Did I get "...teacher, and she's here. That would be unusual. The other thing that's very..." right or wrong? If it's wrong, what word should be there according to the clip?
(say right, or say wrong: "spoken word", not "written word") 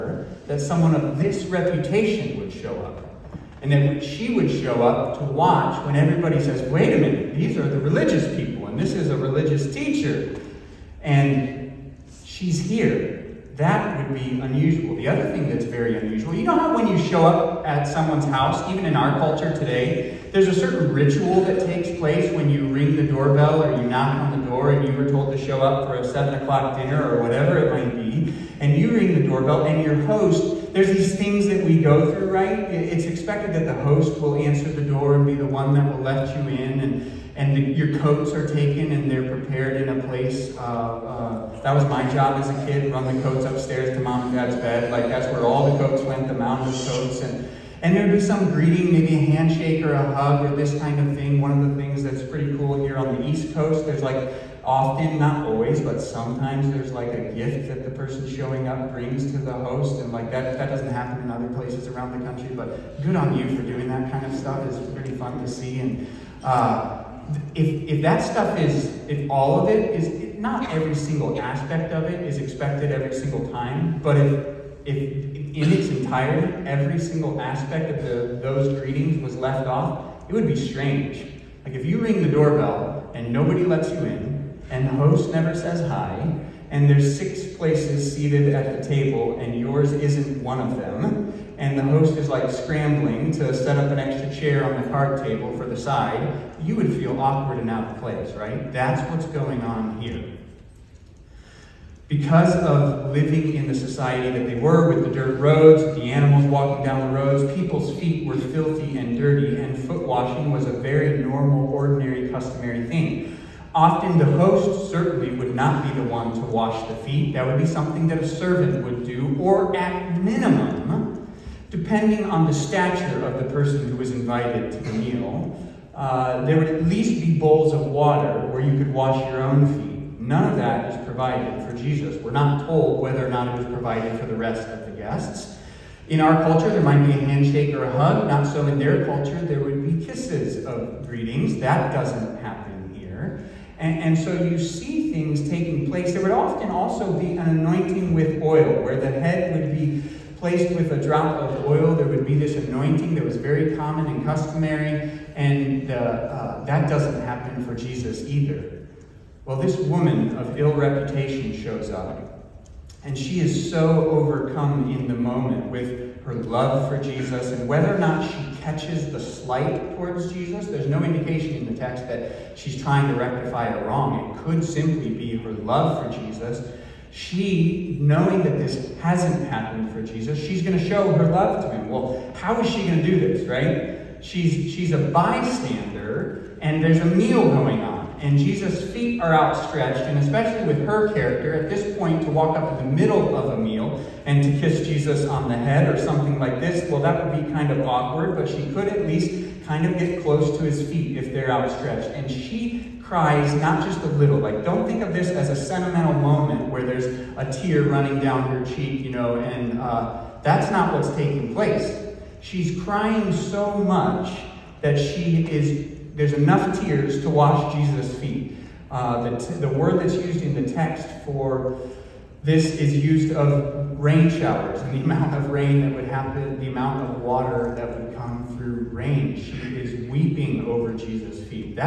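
right.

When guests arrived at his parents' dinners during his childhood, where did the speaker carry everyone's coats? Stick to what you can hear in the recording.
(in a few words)
Mom and dad's bed.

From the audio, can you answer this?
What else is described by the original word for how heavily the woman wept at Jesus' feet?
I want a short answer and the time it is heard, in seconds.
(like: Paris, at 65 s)
Rain showers, at 223 s.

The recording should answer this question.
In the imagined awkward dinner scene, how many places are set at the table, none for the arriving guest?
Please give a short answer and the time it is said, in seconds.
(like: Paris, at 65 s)
6, at 87 s.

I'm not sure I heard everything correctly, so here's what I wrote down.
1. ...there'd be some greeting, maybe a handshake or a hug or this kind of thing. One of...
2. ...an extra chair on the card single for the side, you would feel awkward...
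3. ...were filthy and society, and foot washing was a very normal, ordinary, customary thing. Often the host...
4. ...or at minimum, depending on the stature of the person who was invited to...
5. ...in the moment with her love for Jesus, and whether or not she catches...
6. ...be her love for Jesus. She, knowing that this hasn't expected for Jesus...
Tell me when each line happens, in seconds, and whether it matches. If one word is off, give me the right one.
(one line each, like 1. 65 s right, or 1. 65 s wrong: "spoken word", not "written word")
1. 47 s right
2. 93 s wrong: "table", not "single"
3. 108 s wrong: "dirty", not "society"
4. 119 s right
5. 164 s right
6. 175 s wrong: "happened", not "expected".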